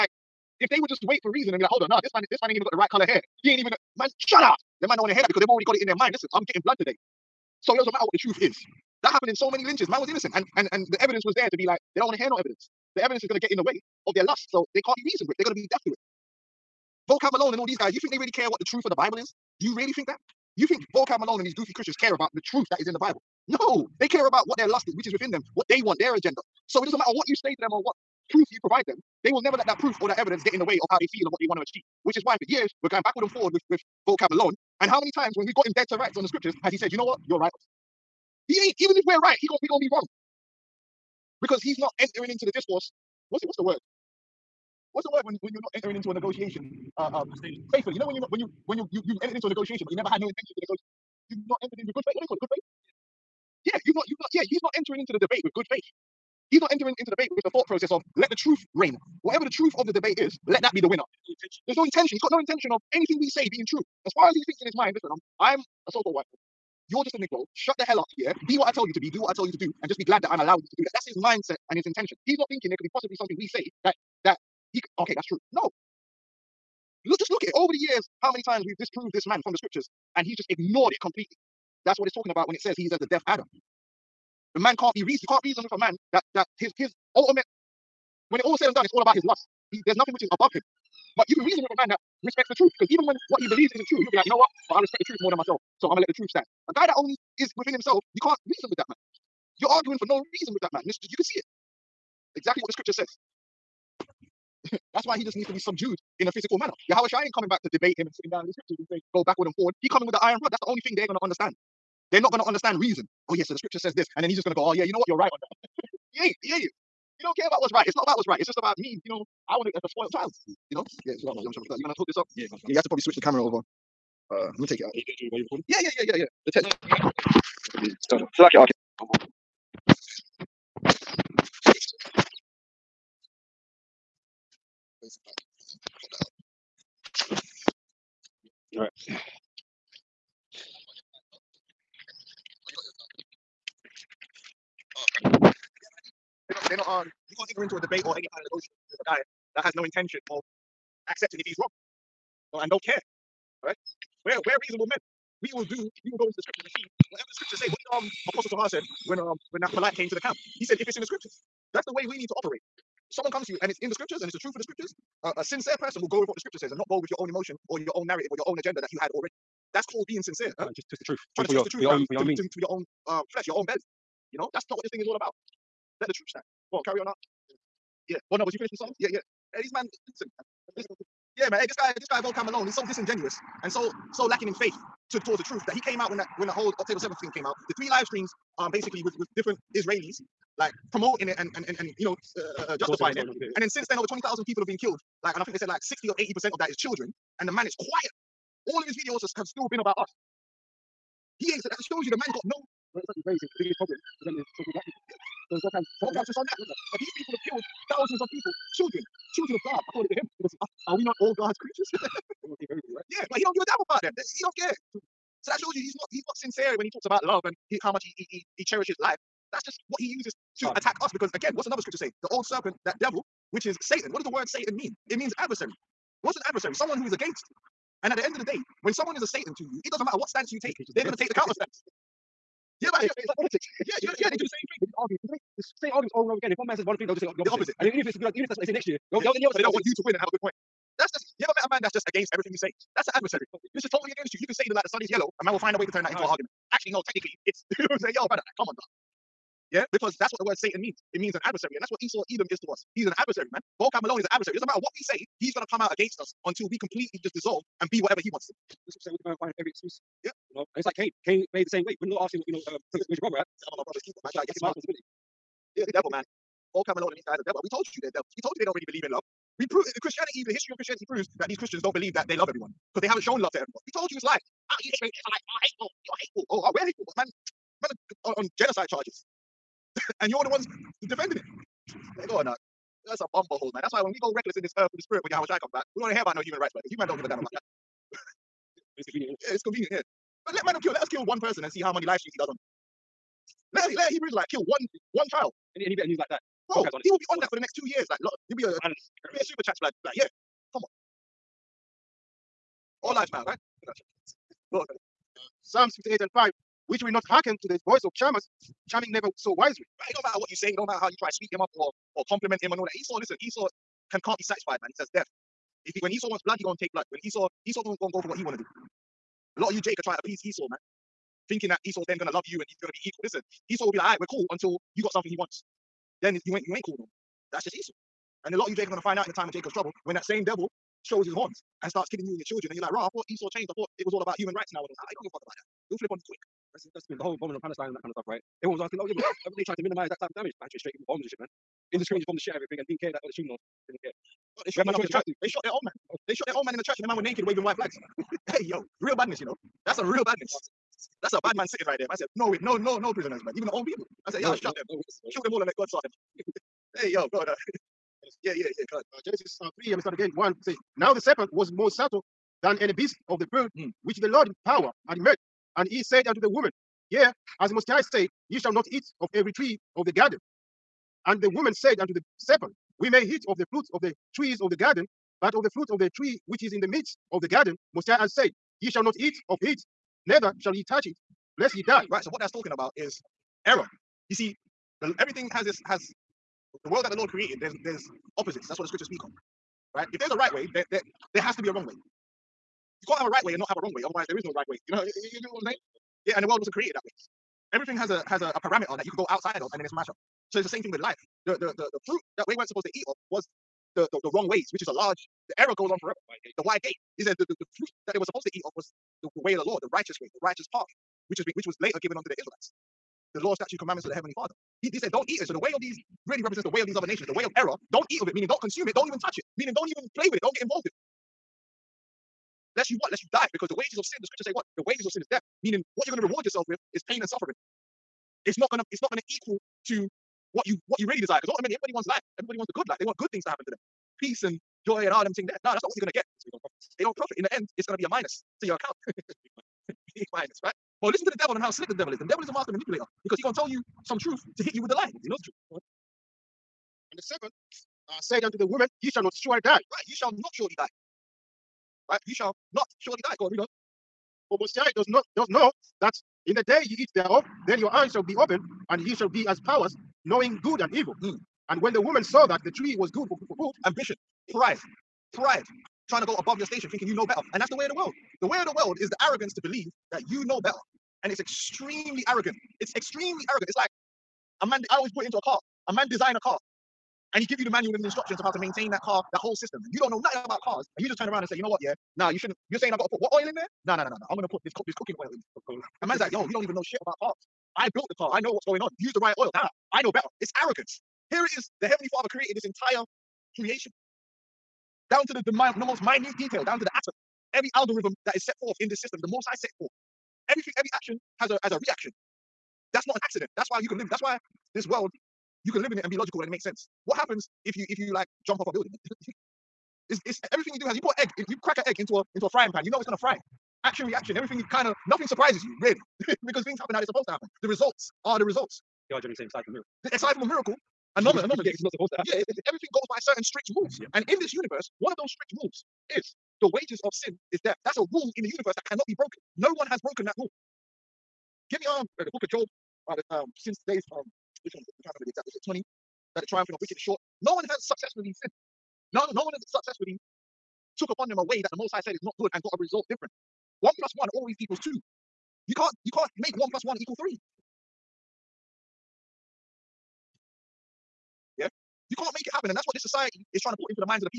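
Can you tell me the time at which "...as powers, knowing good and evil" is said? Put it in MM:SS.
07:39.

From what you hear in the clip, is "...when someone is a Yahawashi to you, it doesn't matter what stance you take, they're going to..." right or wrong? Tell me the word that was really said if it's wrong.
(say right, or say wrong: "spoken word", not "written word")
wrong: "Satan", not "Yahawashi".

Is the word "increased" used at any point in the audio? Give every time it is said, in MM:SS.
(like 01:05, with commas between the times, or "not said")
not said.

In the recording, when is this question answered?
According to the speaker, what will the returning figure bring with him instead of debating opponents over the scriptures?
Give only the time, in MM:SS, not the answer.
01:50.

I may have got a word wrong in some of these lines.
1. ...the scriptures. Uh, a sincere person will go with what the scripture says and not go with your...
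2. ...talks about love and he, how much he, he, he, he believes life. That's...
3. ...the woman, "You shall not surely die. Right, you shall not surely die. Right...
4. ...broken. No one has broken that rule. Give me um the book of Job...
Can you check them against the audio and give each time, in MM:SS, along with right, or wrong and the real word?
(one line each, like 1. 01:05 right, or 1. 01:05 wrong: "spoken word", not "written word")
1. 02:44 right
2. 03:36 wrong: "cherishes", not "believes"
3. 07:28 right
4. 08:49 right.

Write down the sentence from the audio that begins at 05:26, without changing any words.
Then you ain't you ain't cool no more.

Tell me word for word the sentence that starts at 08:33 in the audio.
Action reaction, everything kind of nothing surprises you really.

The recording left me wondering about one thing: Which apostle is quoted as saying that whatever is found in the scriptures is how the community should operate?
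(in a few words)
Apostle Sahar.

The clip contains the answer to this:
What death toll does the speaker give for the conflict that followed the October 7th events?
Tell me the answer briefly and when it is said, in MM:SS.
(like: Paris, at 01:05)
over 20,000, at 03:13.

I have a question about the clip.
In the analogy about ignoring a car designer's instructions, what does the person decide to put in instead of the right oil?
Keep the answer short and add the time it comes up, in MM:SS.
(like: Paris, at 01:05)
cooking oil, at 08:04.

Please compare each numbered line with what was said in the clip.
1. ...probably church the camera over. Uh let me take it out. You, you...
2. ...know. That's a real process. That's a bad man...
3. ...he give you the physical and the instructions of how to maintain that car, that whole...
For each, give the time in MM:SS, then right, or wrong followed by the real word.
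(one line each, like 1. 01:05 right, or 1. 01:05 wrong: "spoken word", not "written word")
1. 02:02 wrong: "switch", not "church"
2. 05:49 wrong: "badness", not "process"
3. 07:57 wrong: "manual", not "physical".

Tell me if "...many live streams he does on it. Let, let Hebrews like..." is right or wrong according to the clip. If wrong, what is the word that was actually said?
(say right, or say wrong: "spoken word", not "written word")
right.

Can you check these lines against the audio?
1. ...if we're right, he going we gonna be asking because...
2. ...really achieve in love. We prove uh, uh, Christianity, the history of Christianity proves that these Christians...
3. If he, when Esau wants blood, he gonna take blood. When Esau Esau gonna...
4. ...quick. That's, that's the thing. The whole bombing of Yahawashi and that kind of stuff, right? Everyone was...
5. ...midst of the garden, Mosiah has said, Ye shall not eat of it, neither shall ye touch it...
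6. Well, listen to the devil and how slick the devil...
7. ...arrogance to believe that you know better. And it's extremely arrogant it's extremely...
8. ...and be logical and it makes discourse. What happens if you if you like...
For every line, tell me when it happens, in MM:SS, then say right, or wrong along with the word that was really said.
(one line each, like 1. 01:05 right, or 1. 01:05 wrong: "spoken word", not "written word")
1. 00:38 wrong: "wrong", not "asking"
2. 04:28 wrong: "believe", not "achieve"
3. 05:15 right
4. 05:36 wrong: "Palestine", not "Yahawashi"
5. 06:16 right
6. 07:21 right
7. 07:49 right
8. 08:26 wrong: "sense", not "discourse".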